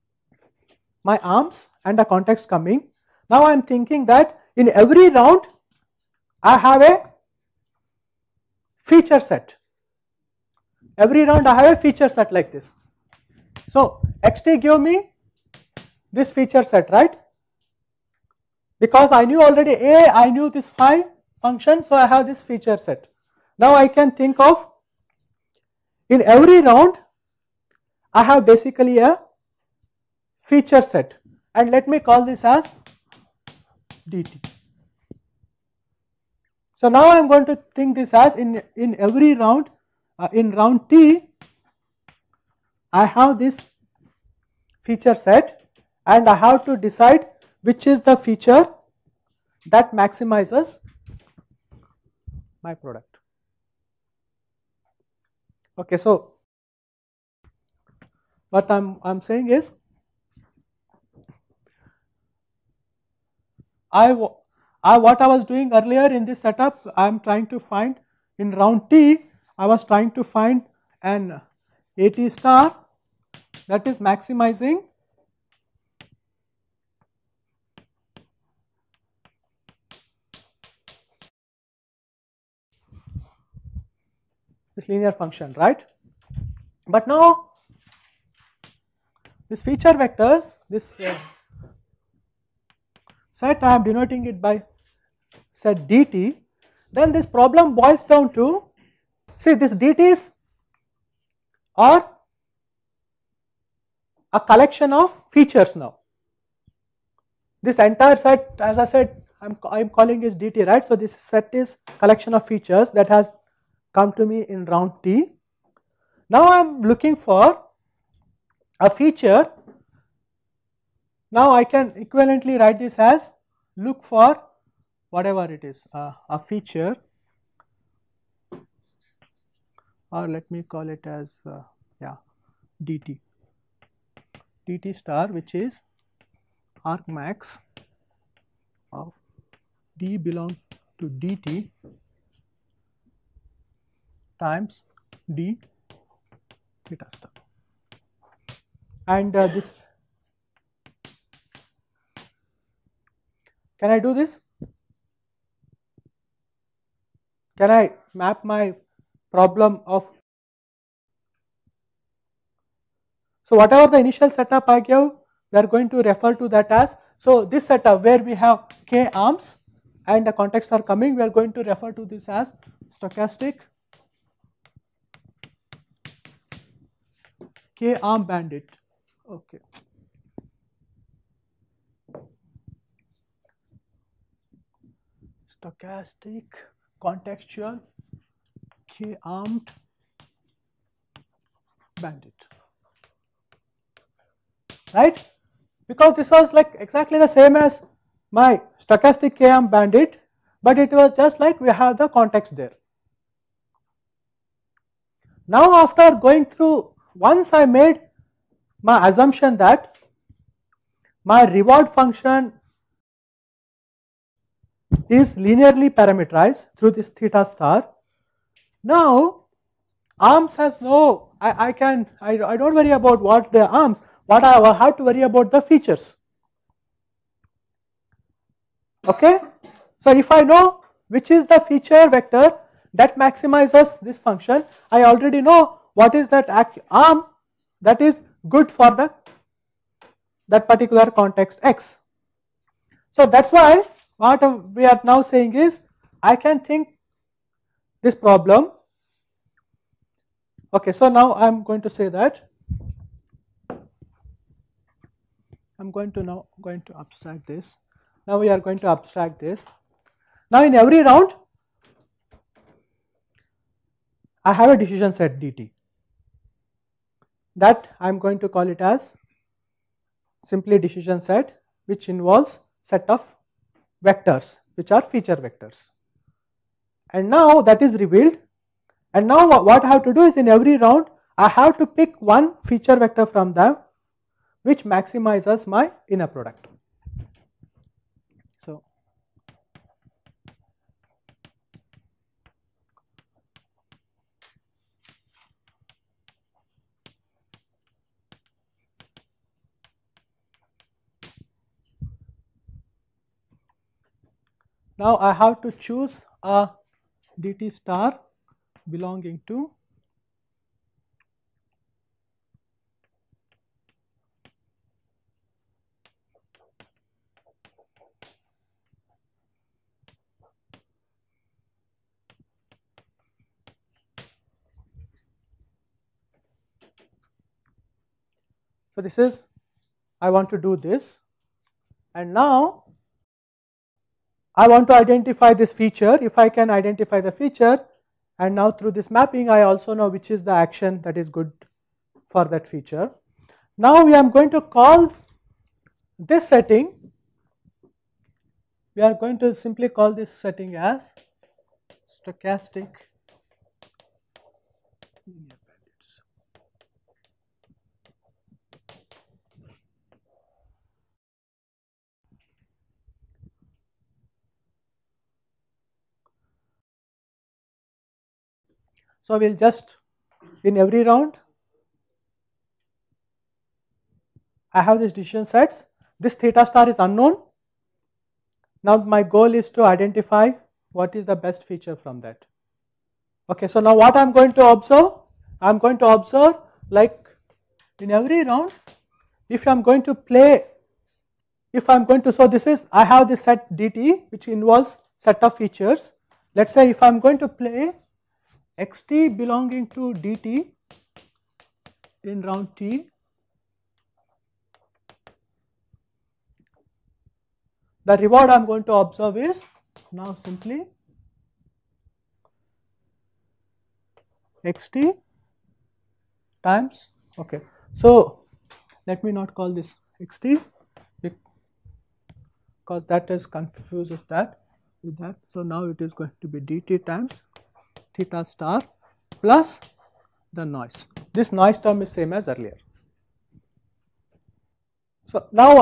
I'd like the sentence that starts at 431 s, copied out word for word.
This noise term is same as earlier.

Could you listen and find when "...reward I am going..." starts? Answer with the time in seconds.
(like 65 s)
408 s.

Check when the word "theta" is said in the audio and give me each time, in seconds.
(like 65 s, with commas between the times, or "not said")
146 s, 217 s, 376 s, 428 s.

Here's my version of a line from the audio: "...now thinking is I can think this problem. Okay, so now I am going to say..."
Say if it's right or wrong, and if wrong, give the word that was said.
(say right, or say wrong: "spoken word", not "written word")
wrong: "saying", not "thinking".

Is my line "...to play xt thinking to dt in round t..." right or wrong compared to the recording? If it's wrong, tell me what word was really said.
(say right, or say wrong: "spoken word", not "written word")
wrong: "belonging", not "thinking".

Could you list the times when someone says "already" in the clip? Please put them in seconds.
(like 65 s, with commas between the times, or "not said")
19 s, 235 s.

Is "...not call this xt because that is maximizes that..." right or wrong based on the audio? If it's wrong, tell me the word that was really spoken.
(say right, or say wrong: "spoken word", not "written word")
wrong: "confuses", not "maximizes".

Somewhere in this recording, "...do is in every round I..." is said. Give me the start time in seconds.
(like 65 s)
280 s.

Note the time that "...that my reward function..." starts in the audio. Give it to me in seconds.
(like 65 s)
209 s.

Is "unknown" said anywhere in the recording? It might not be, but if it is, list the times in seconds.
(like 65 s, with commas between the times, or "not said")
376 s.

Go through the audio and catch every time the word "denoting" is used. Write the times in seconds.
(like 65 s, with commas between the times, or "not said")
93 s.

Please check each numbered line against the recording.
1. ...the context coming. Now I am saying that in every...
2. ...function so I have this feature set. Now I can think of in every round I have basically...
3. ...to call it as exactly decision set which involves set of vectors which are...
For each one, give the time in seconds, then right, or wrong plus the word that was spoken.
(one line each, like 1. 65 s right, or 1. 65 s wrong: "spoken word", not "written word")
1. 1 s wrong: "thinking", not "saying"
2. 21 s right
3. 268 s wrong: "simply", not "exactly".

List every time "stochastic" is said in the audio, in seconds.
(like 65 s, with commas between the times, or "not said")
172 s, 185 s, 198 s, 352 s.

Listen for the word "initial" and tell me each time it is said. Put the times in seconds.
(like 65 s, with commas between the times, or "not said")
164 s.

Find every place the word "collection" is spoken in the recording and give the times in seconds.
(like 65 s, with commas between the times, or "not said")
104 s, 111 s.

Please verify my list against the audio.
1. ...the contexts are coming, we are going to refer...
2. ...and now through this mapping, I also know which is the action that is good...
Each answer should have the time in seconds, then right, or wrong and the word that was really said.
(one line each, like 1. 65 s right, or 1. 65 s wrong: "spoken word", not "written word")
1. 170 s right
2. 338 s right.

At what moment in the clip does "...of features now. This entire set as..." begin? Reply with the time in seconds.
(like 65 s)
104 s.